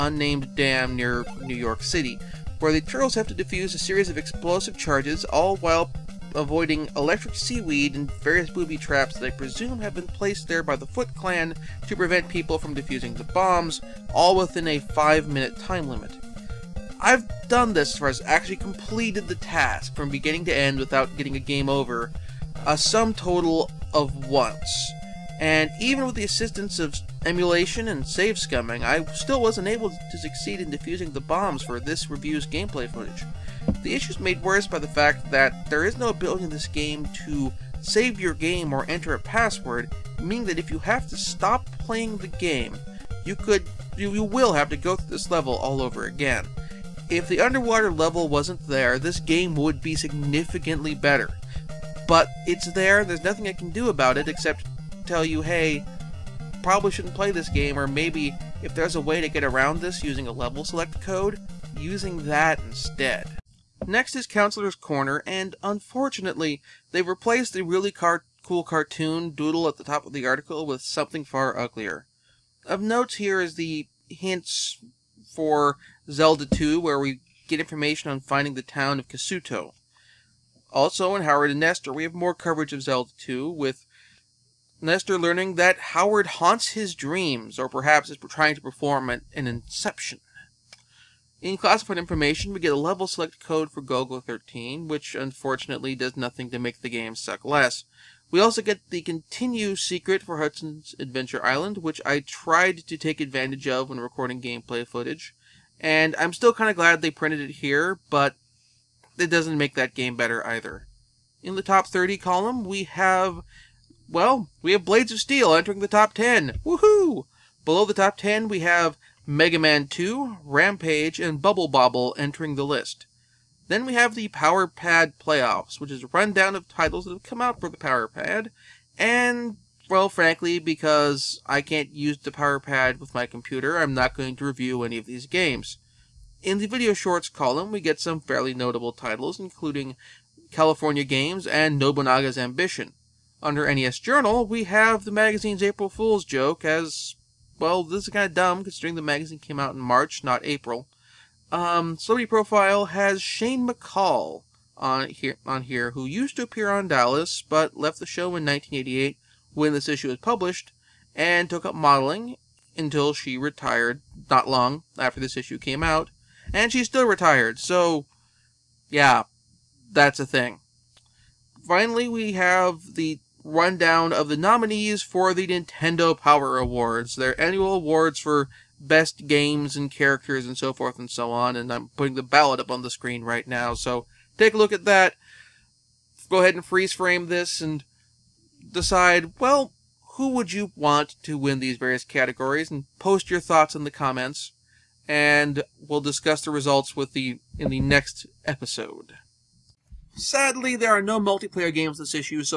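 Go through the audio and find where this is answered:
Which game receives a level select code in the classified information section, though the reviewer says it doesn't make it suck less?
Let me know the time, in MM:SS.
01:33.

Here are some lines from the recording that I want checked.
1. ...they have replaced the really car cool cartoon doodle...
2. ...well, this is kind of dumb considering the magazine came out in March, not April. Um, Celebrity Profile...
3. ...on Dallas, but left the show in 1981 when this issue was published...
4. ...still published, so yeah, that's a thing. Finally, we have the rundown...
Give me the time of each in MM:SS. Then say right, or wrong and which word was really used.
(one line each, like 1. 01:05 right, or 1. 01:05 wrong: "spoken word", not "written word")
1. 01:06 right
2. 02:27 right
3. 02:36 wrong: "1988", not "1981"
4. 02:46 wrong: "retired", not "published".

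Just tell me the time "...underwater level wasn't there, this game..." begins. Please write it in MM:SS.
00:47.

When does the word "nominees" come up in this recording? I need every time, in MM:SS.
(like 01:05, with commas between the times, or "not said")
02:54.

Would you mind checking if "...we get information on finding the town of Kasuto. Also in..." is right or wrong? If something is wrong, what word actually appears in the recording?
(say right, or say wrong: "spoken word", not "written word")
right.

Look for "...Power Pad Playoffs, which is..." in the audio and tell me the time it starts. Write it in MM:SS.
02:04.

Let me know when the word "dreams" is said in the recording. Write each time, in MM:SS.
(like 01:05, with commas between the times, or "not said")
01:26.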